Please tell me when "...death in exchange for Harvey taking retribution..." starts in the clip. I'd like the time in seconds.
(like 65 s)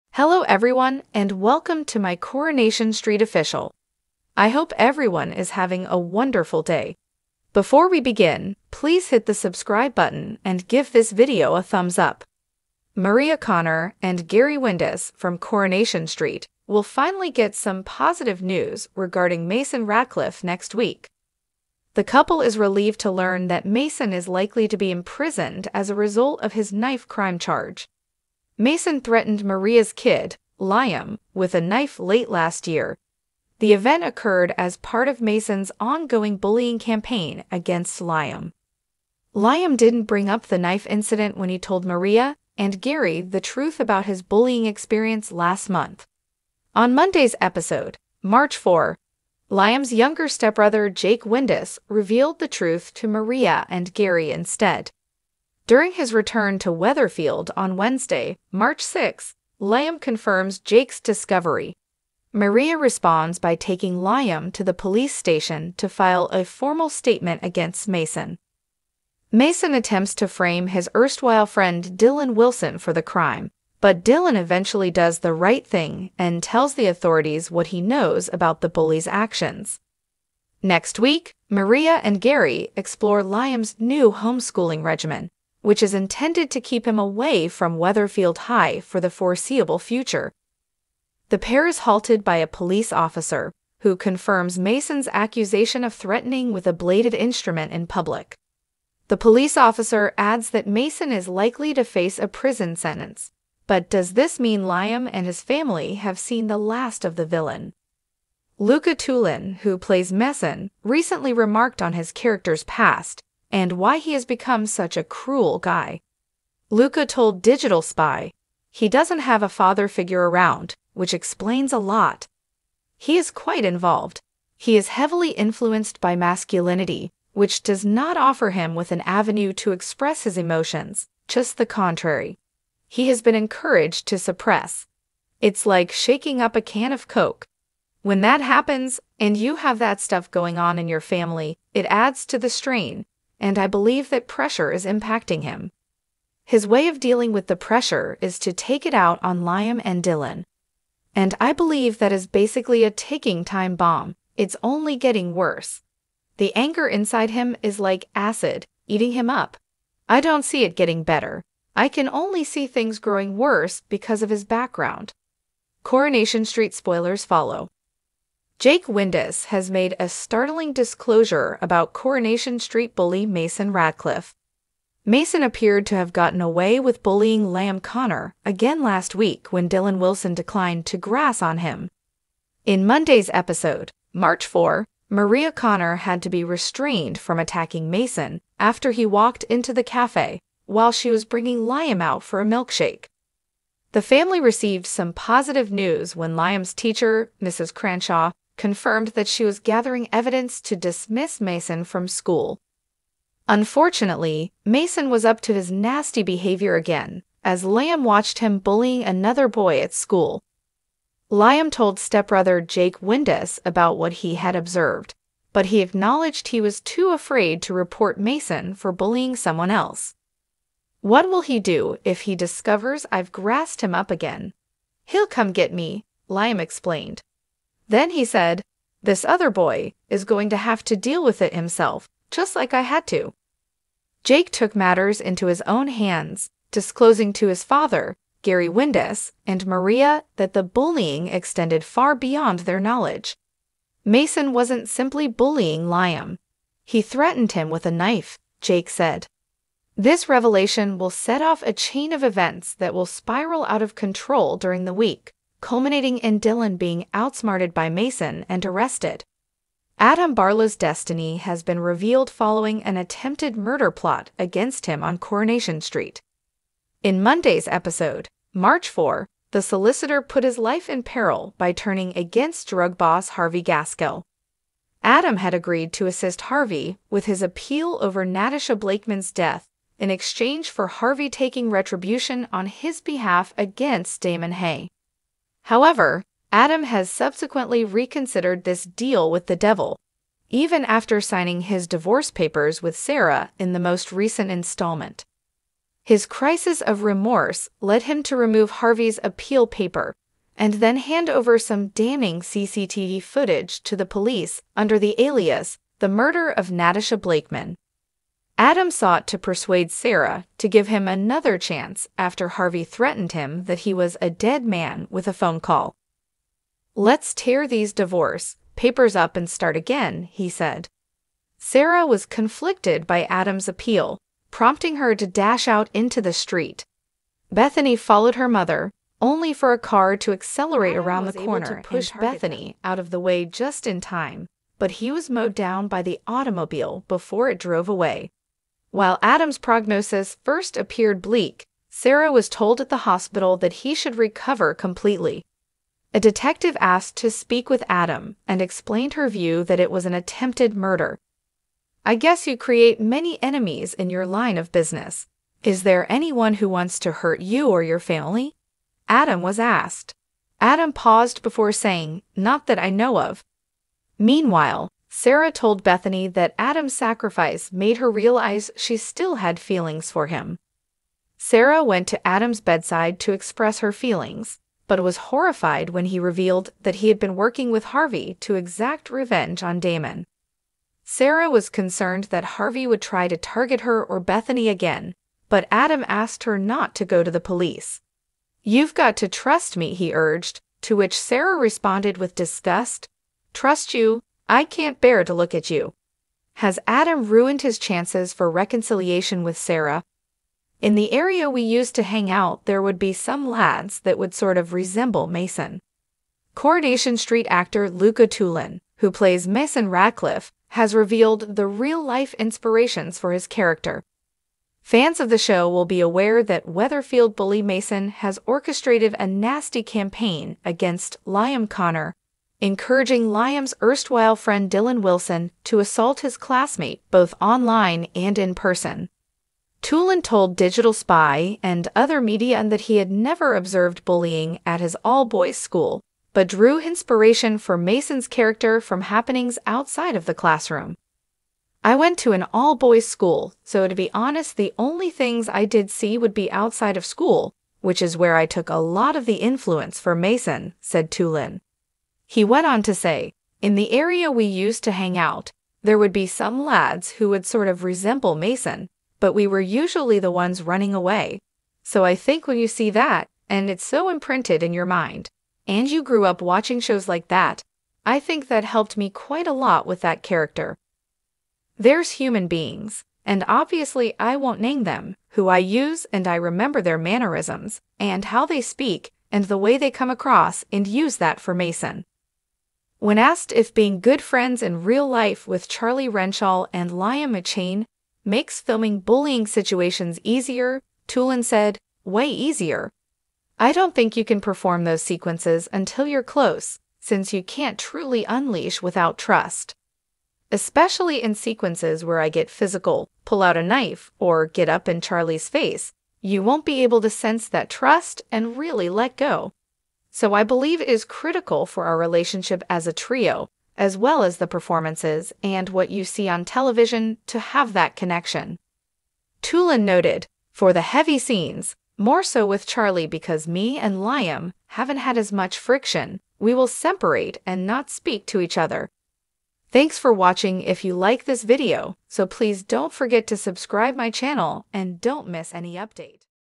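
279 s.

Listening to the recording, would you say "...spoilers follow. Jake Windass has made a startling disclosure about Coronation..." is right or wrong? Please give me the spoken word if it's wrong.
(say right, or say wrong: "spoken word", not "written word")
right.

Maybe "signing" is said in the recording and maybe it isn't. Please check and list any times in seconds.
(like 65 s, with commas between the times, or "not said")
291 s.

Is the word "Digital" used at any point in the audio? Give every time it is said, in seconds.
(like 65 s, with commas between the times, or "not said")
117 s, 430 s.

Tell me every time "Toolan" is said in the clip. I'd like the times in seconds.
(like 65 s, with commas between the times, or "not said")
108 s, 408 s, 429 s, 451 s, 491 s, 519 s.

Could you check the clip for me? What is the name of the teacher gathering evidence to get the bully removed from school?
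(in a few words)
Mrs. Cranshaw.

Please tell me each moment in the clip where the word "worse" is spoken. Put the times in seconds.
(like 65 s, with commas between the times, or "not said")
155 s, 163 s.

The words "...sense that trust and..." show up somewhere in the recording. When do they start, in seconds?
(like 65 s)
507 s.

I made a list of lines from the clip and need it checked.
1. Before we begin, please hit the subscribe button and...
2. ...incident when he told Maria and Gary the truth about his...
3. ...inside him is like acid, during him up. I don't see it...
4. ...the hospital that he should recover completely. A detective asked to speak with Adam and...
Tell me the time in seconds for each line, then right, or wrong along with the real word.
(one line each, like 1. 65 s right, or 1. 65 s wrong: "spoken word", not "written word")
1. 7 s right
2. 40 s right
3. 156 s wrong: "eating", not "during"
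4. 342 s right.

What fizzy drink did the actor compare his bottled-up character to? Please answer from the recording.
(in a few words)
Coke.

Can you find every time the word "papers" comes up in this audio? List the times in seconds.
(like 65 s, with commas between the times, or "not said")
292 s, 299 s, 318 s.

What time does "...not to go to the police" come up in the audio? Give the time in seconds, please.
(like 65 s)
386 s.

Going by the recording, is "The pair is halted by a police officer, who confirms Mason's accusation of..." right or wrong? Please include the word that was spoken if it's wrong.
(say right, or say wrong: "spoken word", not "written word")
right.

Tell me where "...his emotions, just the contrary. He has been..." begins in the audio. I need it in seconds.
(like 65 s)
130 s.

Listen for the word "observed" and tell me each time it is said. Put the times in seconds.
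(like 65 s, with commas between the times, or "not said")
214 s, 433 s.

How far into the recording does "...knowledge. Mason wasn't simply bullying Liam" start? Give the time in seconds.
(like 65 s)
242 s.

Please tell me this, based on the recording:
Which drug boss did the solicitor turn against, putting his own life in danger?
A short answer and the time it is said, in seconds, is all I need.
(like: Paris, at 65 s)
Harvey Gaskell, at 273 s.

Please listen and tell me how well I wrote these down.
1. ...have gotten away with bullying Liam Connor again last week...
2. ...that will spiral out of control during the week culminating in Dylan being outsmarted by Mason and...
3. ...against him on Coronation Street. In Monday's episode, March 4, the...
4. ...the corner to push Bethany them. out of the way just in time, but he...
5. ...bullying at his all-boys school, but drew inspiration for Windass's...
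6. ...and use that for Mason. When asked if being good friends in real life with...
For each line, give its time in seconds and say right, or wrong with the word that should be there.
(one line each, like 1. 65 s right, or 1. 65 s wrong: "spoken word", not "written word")
1. 175 s right
2. 252 s right
3. 264 s right
4. 331 s right
5. 434 s wrong: "Mason", not "Windass"
6. 480 s right.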